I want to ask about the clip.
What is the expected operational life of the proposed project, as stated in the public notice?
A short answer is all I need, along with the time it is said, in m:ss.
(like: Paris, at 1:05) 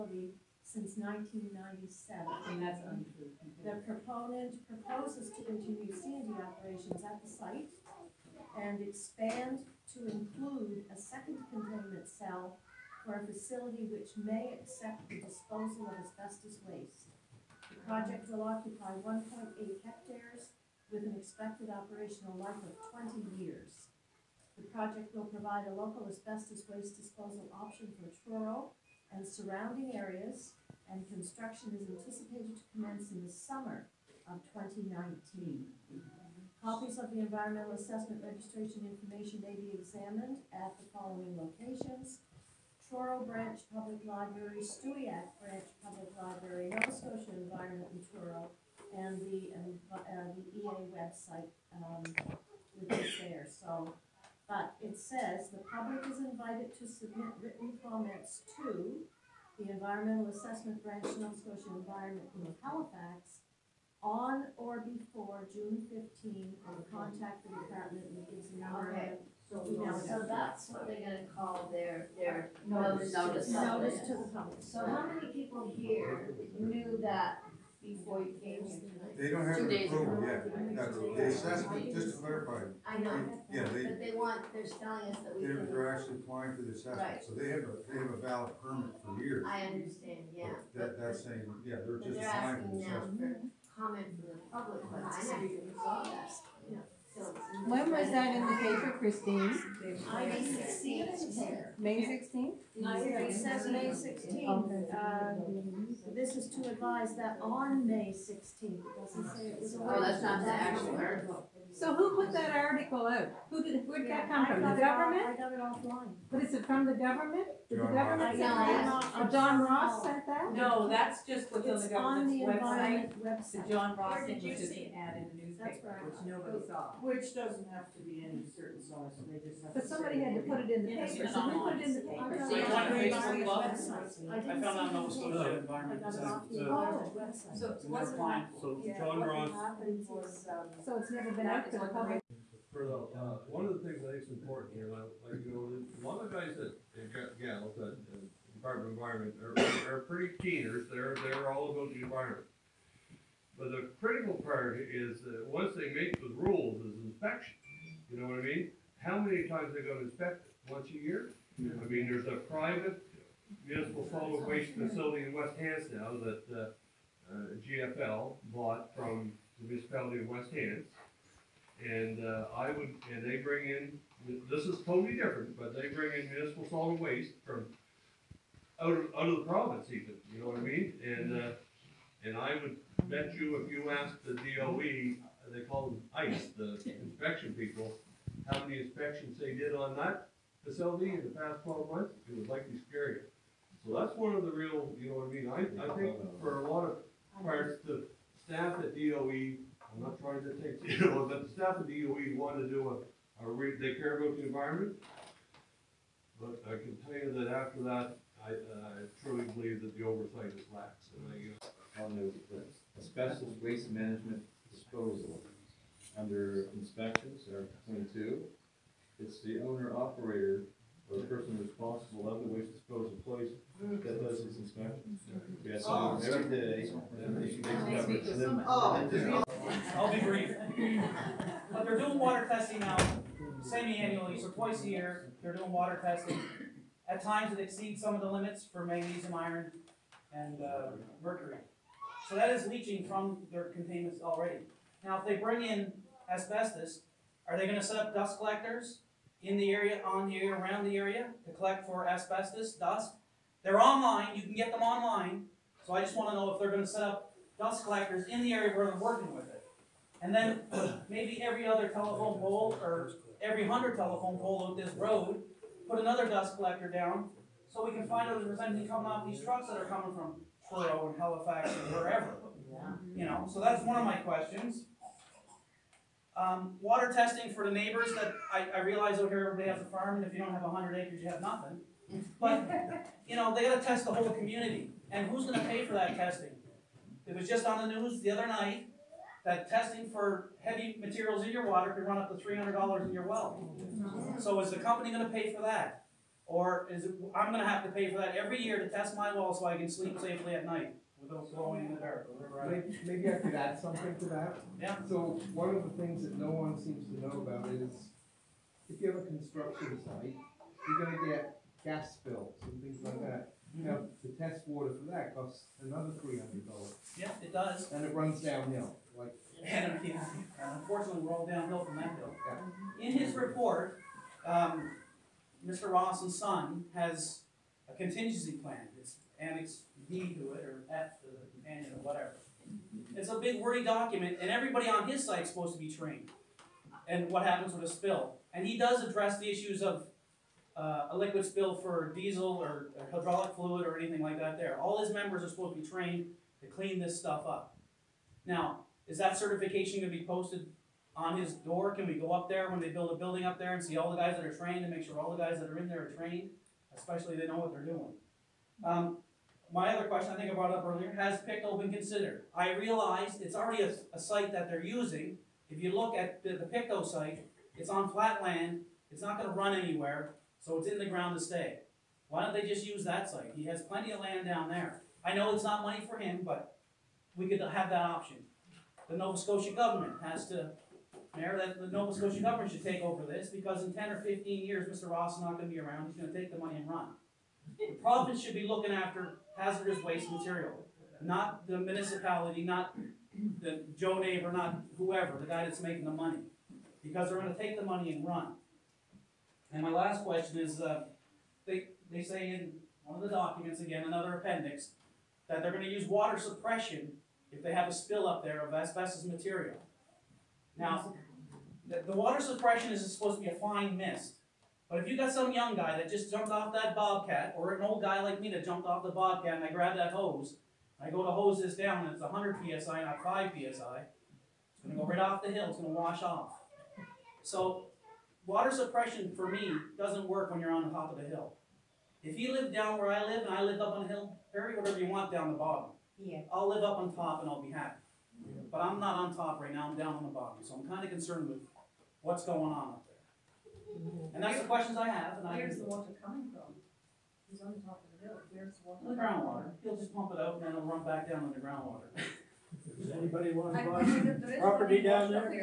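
20 years, at 0:22.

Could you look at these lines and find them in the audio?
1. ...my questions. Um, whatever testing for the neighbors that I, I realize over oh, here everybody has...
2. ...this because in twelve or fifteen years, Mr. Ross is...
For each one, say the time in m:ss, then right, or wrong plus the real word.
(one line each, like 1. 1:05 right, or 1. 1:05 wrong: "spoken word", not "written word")
1. 4:34 wrong: "water", not "whatever"
2. 6:23 wrong: "ten", not "twelve".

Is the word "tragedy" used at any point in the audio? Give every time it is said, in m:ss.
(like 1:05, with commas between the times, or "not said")
not said.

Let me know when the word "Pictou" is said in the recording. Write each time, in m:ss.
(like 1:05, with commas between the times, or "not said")
6:01, 6:06.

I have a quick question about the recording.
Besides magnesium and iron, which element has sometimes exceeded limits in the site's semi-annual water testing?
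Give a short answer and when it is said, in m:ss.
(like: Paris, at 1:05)
Mercury, at 4:01.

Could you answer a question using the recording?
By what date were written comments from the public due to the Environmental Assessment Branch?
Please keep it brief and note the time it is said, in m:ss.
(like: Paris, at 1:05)
June 15, at 1:05.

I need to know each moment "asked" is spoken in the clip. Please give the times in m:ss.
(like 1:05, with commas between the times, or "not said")
3:03.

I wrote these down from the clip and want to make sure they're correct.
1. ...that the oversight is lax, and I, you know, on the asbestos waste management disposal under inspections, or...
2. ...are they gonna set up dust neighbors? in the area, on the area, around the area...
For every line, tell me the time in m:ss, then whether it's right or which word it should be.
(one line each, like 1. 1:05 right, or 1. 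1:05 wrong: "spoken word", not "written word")
1. 3:29 right
2. 4:07 wrong: "collectors", not "neighbors".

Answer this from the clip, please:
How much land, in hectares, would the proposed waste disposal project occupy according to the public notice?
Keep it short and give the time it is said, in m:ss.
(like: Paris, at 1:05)
1.8 hectares, at 0:19.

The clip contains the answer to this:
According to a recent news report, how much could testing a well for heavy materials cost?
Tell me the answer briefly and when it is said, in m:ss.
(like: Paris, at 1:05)
$300, at 4:52.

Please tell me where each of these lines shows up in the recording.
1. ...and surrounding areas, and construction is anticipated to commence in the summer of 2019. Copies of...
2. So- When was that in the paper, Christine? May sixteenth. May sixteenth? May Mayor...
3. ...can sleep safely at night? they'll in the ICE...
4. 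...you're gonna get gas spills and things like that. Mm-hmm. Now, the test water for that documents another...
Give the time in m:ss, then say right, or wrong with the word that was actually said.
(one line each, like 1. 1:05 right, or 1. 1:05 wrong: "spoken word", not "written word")
1. 0:29 right
2. 1:36 wrong: "Okay", not "Mayor"
3. 4:59 wrong: "Maybe", not "ICE"
4. 5:10 wrong: "costs", not "documents".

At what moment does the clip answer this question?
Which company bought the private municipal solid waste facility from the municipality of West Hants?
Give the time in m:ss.
2:47.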